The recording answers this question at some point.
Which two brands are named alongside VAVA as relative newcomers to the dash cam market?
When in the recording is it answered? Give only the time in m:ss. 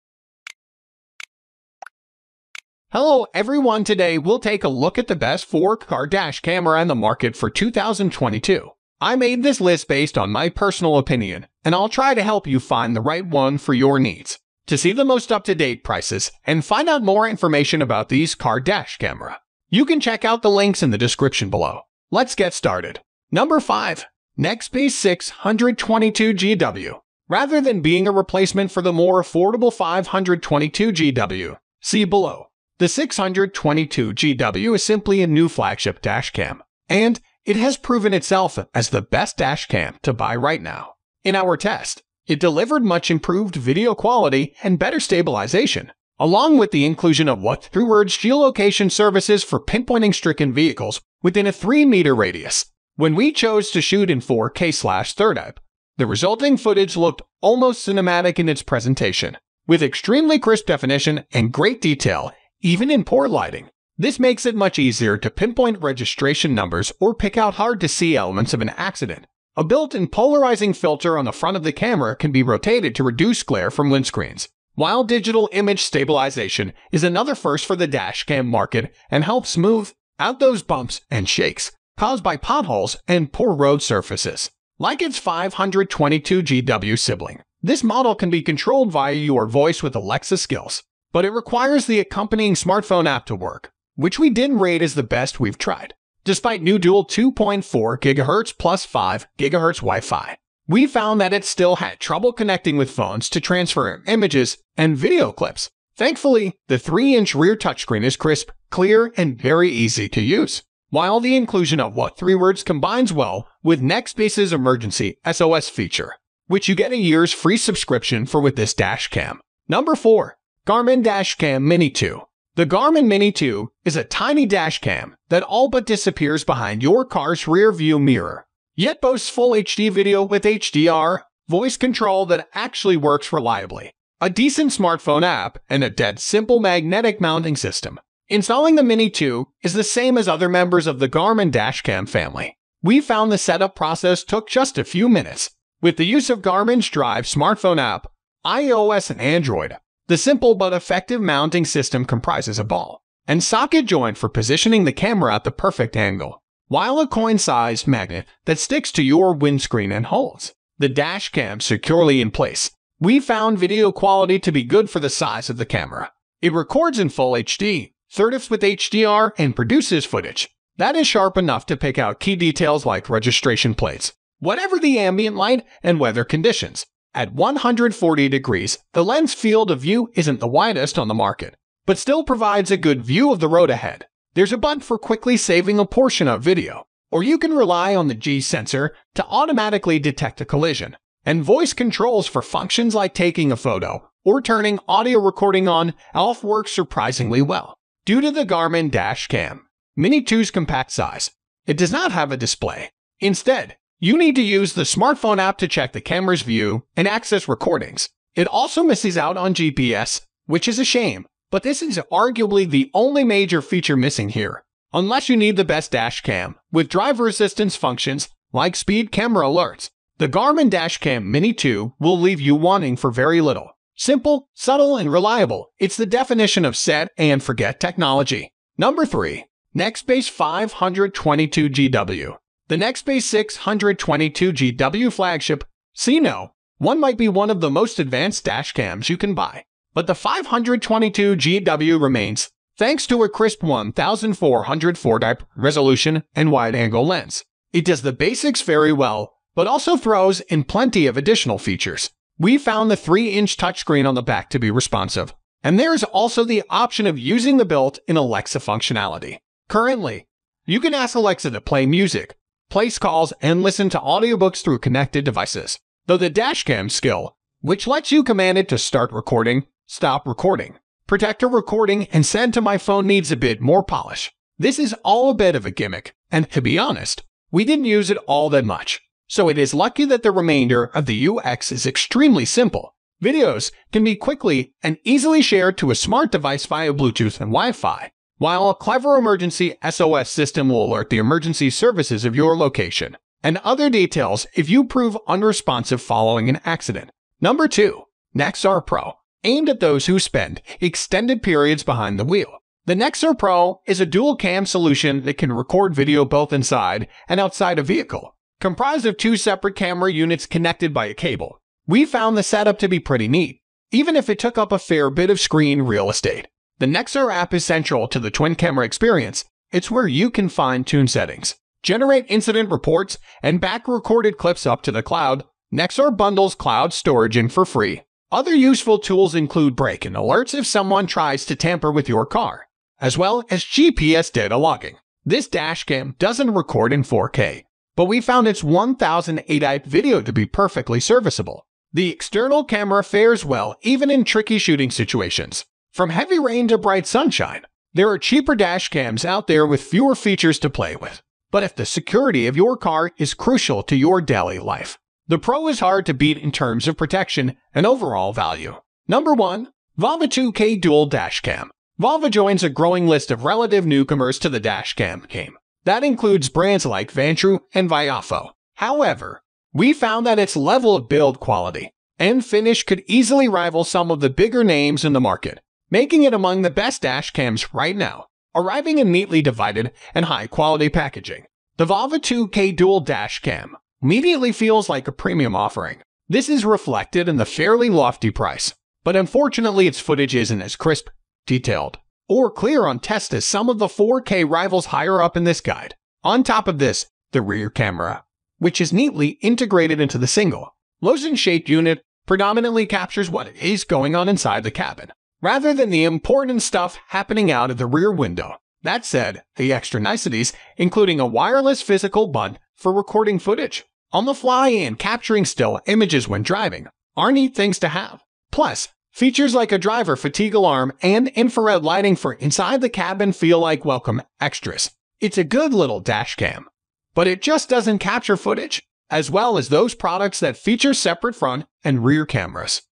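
6:07.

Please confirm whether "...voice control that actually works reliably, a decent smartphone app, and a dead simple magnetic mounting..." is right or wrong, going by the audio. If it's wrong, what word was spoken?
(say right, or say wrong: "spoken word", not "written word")
right.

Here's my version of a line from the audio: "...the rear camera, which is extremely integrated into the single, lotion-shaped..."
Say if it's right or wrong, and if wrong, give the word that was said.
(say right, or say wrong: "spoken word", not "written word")
wrong: "neatly", not "extremely".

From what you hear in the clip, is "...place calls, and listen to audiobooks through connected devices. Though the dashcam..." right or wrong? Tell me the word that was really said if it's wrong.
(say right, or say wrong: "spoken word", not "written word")
right.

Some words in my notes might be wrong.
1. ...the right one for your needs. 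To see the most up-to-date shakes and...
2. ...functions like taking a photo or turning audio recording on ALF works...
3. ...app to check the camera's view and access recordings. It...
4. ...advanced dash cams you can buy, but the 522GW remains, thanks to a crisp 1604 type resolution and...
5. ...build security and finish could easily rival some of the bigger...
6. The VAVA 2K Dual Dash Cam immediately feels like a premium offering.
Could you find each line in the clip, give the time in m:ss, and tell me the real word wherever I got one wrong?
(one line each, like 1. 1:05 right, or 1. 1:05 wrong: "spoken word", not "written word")
1. 0:12 wrong: "prices", not "shakes"
2. 3:12 right
3. 3:25 right
4. 3:57 wrong: "1404", not "1604"
5. 6:11 wrong: "quality", not "security"
6. 6:21 right.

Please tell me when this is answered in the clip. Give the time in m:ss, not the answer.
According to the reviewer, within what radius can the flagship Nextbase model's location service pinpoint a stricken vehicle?
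0:51.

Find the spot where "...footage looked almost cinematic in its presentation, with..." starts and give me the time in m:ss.
0:56.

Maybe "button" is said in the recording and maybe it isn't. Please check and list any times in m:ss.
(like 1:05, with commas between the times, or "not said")
3:04, 6:52.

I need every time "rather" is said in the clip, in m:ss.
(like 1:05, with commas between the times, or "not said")
0:27, 6:45.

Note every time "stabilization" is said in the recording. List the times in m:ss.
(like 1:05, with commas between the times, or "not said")
0:44, 1:15.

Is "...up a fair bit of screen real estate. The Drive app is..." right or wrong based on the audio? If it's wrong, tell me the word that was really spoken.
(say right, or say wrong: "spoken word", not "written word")
wrong: "Nexar", not "Drive".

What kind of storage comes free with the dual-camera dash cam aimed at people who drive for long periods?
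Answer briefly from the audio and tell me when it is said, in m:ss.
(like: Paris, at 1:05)
Cloud storage, at 5:26.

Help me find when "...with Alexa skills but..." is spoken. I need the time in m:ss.
1:29.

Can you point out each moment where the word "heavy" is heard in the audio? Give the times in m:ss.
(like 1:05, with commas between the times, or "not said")
5:46.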